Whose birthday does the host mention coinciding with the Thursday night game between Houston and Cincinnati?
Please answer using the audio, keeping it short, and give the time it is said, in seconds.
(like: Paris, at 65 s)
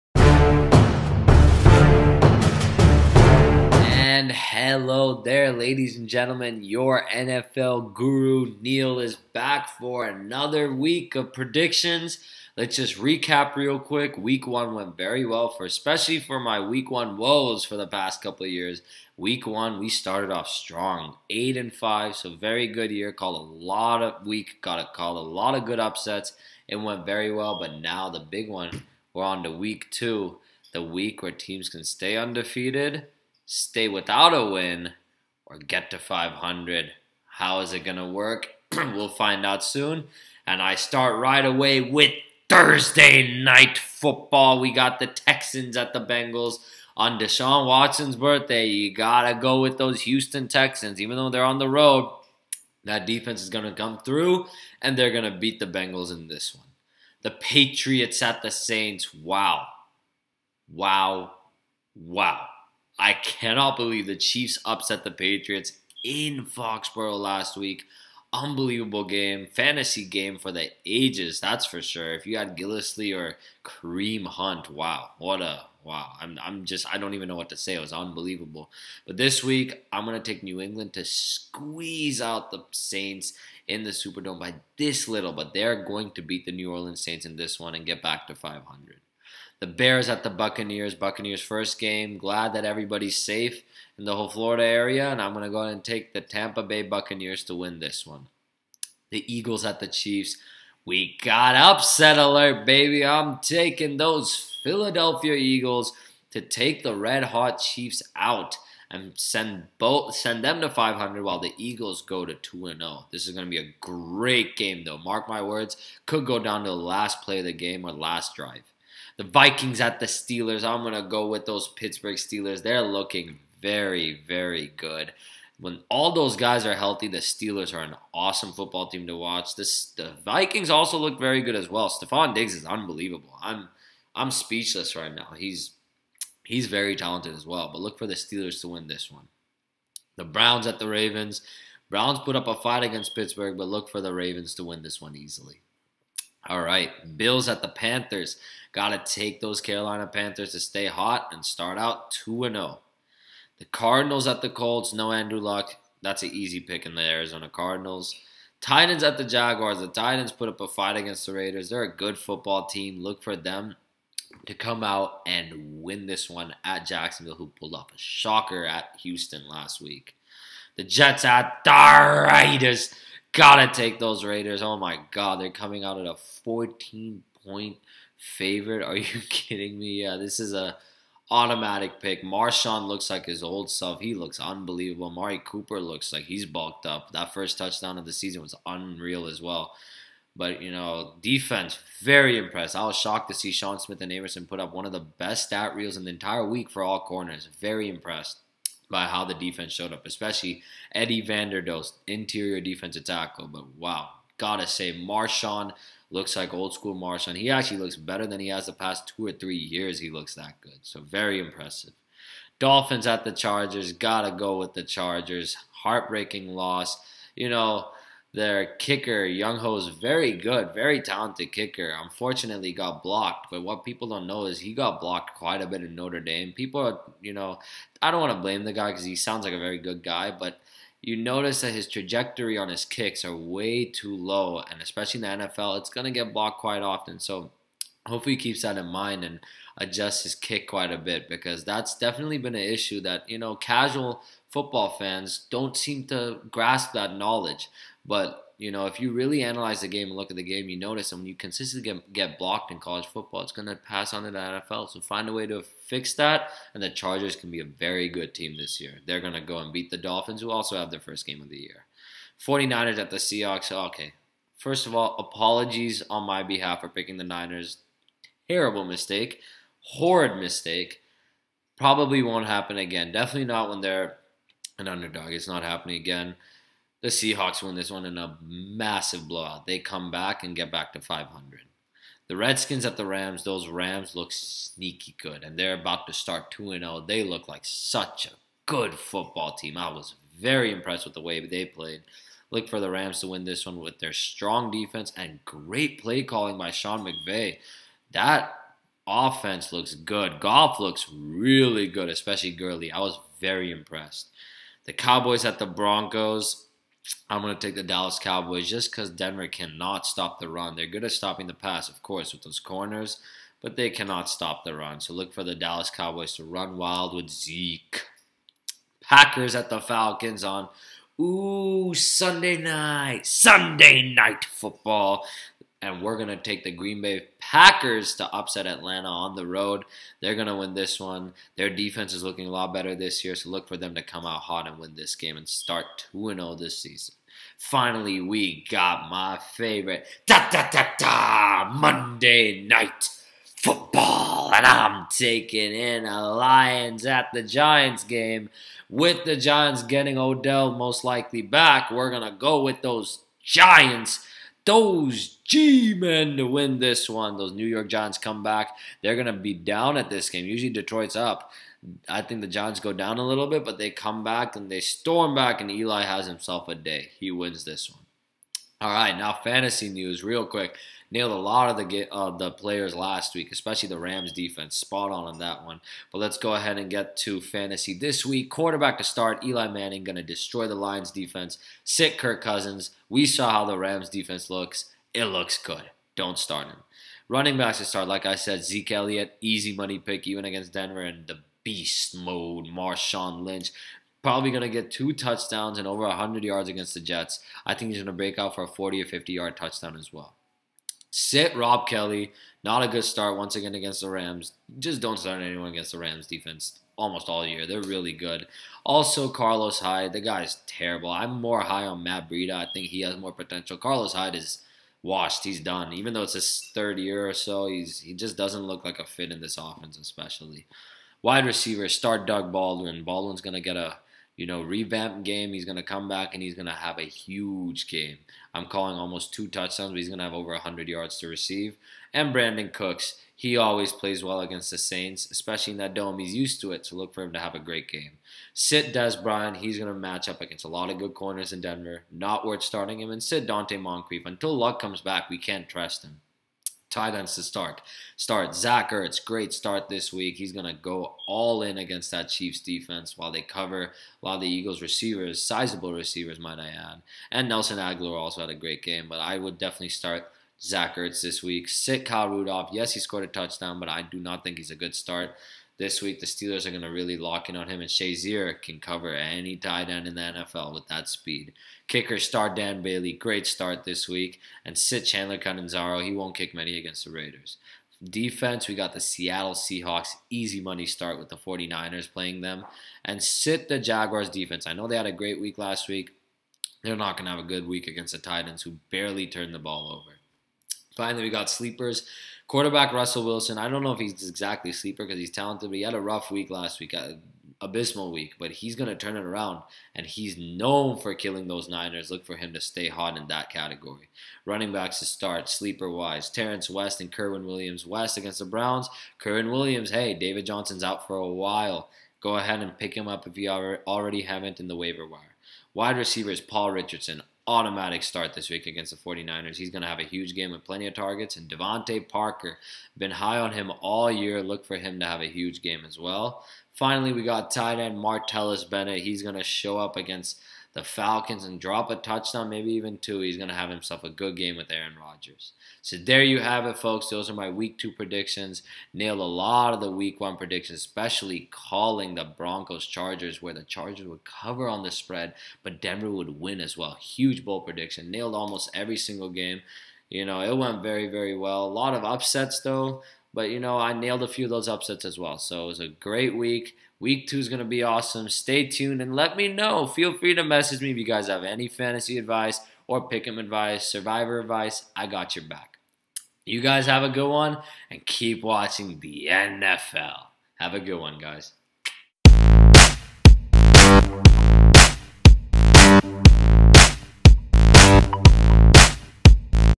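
Deshaun Watson, at 47 s.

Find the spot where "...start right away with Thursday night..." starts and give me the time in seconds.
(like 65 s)
40 s.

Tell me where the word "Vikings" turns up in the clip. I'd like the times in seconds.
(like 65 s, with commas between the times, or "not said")
119 s, 130 s.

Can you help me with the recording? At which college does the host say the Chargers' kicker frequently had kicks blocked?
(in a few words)
Notre Dame.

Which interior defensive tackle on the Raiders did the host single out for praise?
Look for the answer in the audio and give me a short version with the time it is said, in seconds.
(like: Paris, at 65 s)
Eddie Vanderdoes, at 200 s.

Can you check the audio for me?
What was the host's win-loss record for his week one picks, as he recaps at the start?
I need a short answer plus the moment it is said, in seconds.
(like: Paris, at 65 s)
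8 and 5, at 21 s.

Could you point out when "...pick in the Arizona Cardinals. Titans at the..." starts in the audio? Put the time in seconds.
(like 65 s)
156 s.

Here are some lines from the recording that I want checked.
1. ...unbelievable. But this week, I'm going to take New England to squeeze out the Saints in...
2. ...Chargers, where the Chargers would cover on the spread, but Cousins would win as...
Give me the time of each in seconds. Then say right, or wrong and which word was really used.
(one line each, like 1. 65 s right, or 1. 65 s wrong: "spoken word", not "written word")
1. 77 s right
2. 542 s wrong: "Denver", not "Cousins".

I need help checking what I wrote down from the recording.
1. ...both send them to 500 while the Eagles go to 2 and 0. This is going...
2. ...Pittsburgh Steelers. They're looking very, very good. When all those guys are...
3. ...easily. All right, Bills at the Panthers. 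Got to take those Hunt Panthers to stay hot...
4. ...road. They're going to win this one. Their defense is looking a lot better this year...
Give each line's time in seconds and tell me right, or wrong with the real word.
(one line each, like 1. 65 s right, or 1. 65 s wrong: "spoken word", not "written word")
1. 109 s right
2. 121 s right
3. 145 s wrong: "Carolina", not "Hunt"
4. 329 s right.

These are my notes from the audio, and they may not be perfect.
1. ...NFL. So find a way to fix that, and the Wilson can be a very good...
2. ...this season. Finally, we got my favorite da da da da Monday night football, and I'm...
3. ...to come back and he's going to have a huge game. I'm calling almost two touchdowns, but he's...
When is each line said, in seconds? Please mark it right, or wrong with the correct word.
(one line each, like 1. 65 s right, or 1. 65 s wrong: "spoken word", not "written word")
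1. 254 s wrong: "Chargers", not "Wilson"
2. 336 s right
3. 425 s right.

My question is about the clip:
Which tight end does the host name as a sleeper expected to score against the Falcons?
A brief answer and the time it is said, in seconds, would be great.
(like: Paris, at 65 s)
Martellus Bennett, at 527 s.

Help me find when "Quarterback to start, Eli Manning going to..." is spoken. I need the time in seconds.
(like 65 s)
378 s.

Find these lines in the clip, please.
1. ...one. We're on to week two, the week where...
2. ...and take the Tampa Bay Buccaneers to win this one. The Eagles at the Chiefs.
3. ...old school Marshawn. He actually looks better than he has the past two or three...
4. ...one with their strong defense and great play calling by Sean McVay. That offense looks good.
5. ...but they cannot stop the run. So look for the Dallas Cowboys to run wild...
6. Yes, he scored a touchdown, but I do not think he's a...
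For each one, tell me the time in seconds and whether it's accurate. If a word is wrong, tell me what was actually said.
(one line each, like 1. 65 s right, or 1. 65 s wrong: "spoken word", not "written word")
1. 28 s right
2. 95 s right
3. 206 s right
4. 293 s right
5. 313 s right
6. 462 s right.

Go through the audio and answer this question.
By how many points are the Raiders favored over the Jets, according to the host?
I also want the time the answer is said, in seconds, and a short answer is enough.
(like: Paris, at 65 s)
14, at 176 s.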